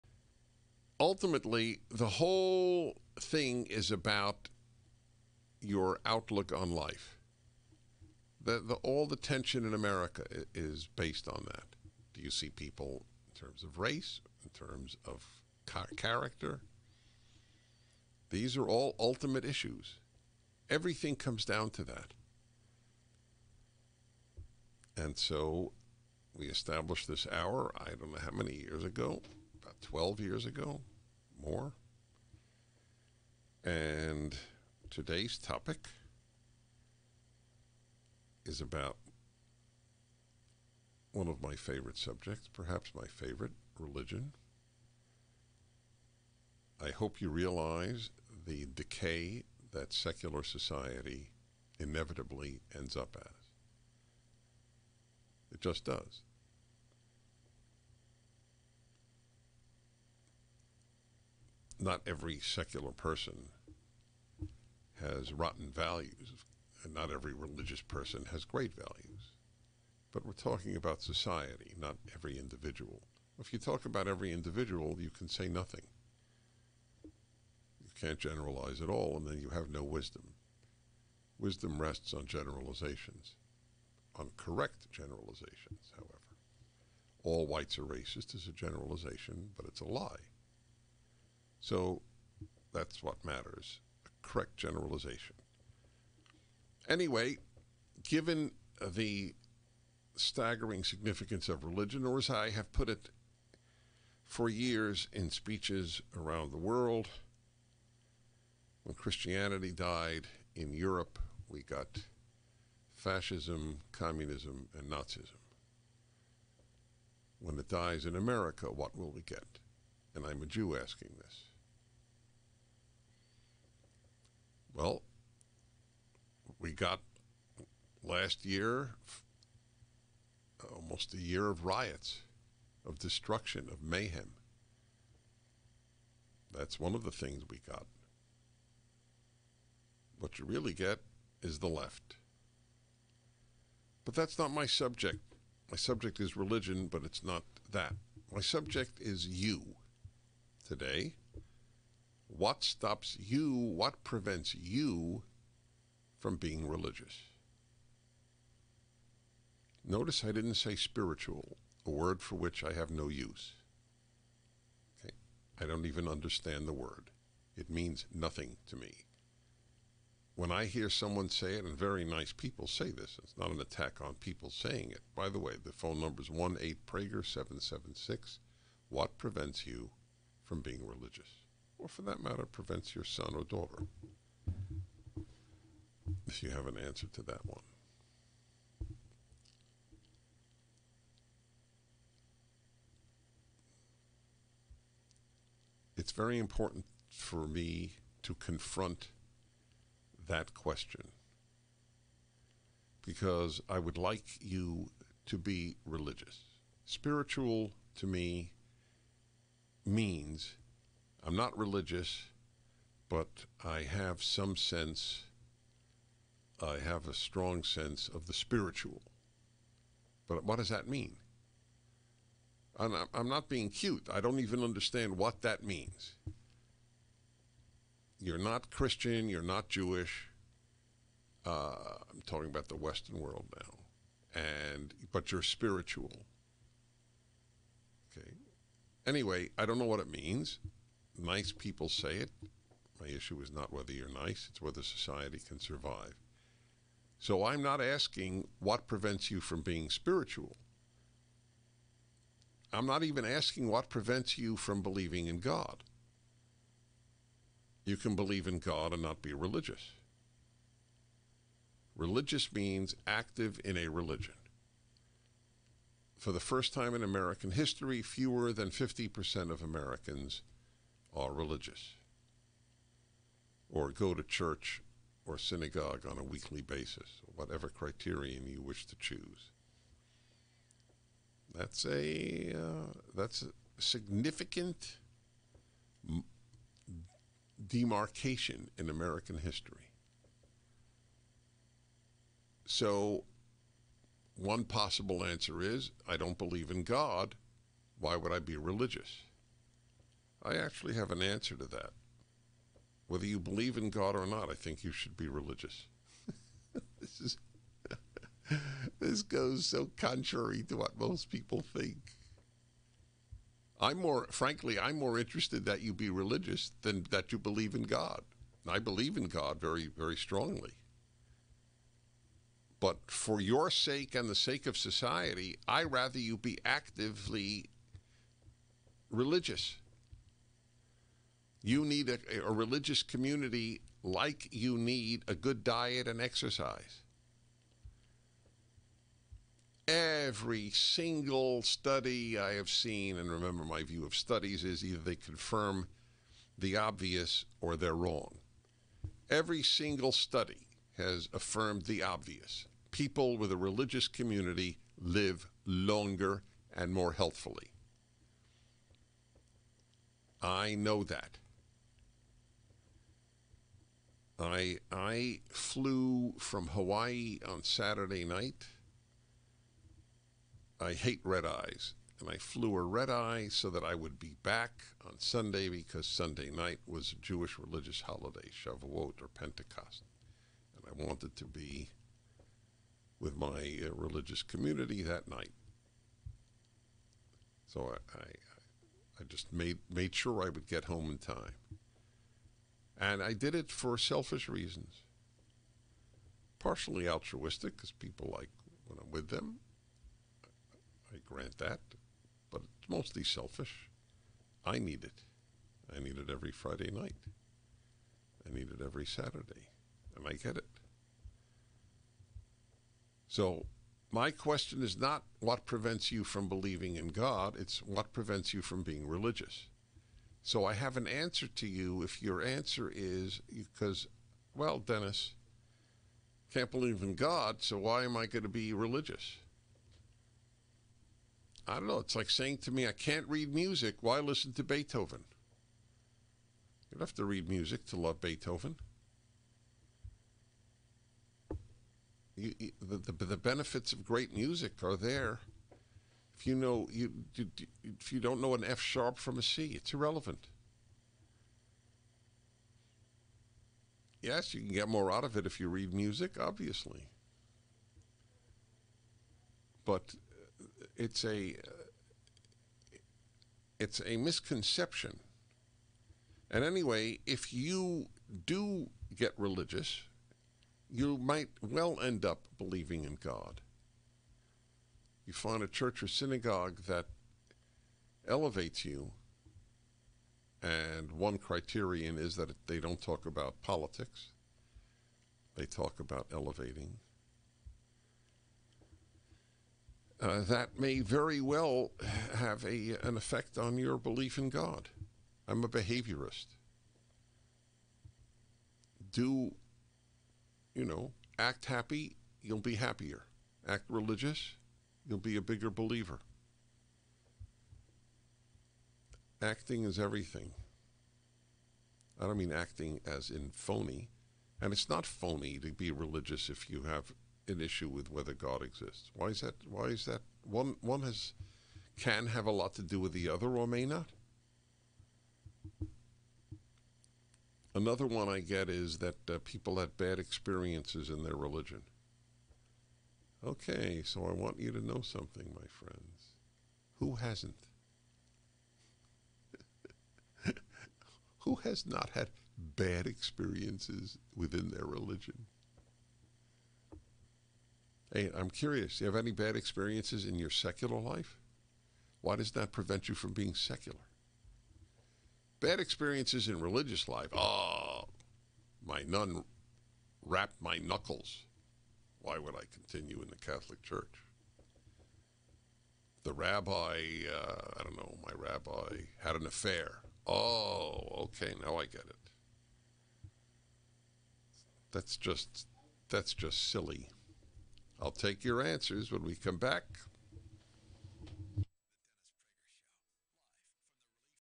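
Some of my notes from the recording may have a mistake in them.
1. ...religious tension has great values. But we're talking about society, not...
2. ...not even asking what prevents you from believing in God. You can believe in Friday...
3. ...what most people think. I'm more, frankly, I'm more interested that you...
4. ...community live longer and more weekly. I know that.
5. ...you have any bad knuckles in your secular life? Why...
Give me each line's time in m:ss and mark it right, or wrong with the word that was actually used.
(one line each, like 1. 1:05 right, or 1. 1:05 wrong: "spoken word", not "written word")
1. 1:07 wrong: "person", not "tension"
2. 4:12 wrong: "God", not "Friday"
3. 5:10 right
4. 5:54 wrong: "healthfully", not "weekly"
5. 9:09 wrong: "experiences", not "knuckles".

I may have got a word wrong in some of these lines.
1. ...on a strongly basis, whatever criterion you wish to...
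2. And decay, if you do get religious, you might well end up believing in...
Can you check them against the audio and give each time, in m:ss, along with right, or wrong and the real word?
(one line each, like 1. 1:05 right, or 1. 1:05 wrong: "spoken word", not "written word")
1. 4:36 wrong: "weekly", not "strongly"
2. 7:46 wrong: "anyway", not "decay".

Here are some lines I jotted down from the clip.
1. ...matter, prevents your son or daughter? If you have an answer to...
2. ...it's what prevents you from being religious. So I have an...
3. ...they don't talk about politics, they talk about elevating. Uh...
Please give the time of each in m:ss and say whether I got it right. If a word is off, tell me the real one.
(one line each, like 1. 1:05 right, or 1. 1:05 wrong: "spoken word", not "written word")
1. 3:02 right
2. 6:57 right
3. 8:02 right.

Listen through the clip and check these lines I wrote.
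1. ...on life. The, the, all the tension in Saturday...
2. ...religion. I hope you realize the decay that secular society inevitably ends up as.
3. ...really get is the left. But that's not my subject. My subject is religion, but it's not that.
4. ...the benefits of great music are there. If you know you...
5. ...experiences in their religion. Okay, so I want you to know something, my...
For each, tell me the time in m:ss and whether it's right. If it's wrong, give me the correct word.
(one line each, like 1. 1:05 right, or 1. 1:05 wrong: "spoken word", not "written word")
1. 0:06 wrong: "America", not "Saturday"
2. 0:43 right
3. 2:20 right
4. 7:23 right
5. 8:50 right.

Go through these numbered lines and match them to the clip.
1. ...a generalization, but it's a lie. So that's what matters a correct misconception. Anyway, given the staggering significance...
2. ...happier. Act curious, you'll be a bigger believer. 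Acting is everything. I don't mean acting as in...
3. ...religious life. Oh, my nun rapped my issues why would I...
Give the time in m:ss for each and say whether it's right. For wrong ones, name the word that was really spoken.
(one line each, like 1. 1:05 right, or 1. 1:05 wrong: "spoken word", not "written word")
1. 1:28 wrong: "generalization", not "misconception"
2. 8:22 wrong: "religious", not "curious"
3. 9:16 wrong: "knuckles", not "issues".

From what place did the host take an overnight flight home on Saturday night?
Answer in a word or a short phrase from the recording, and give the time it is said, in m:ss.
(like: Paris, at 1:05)
Hawaii, at 6:06.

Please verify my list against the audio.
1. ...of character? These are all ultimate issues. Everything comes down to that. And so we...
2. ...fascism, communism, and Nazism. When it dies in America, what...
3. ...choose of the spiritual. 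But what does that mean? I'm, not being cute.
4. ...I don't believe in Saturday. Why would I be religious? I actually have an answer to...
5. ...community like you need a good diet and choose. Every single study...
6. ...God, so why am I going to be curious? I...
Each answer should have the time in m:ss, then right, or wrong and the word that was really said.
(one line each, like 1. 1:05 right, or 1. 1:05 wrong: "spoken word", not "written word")
1. 0:15 right
2. 1:52 right
3. 3:37 wrong: "sense", not "choose"
4. 4:56 wrong: "God", not "Saturday"
5. 5:33 wrong: "exercise", not "choose"
6. 7:07 wrong: "religious", not "curious".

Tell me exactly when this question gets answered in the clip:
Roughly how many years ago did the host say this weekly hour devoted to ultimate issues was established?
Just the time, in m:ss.
0:29.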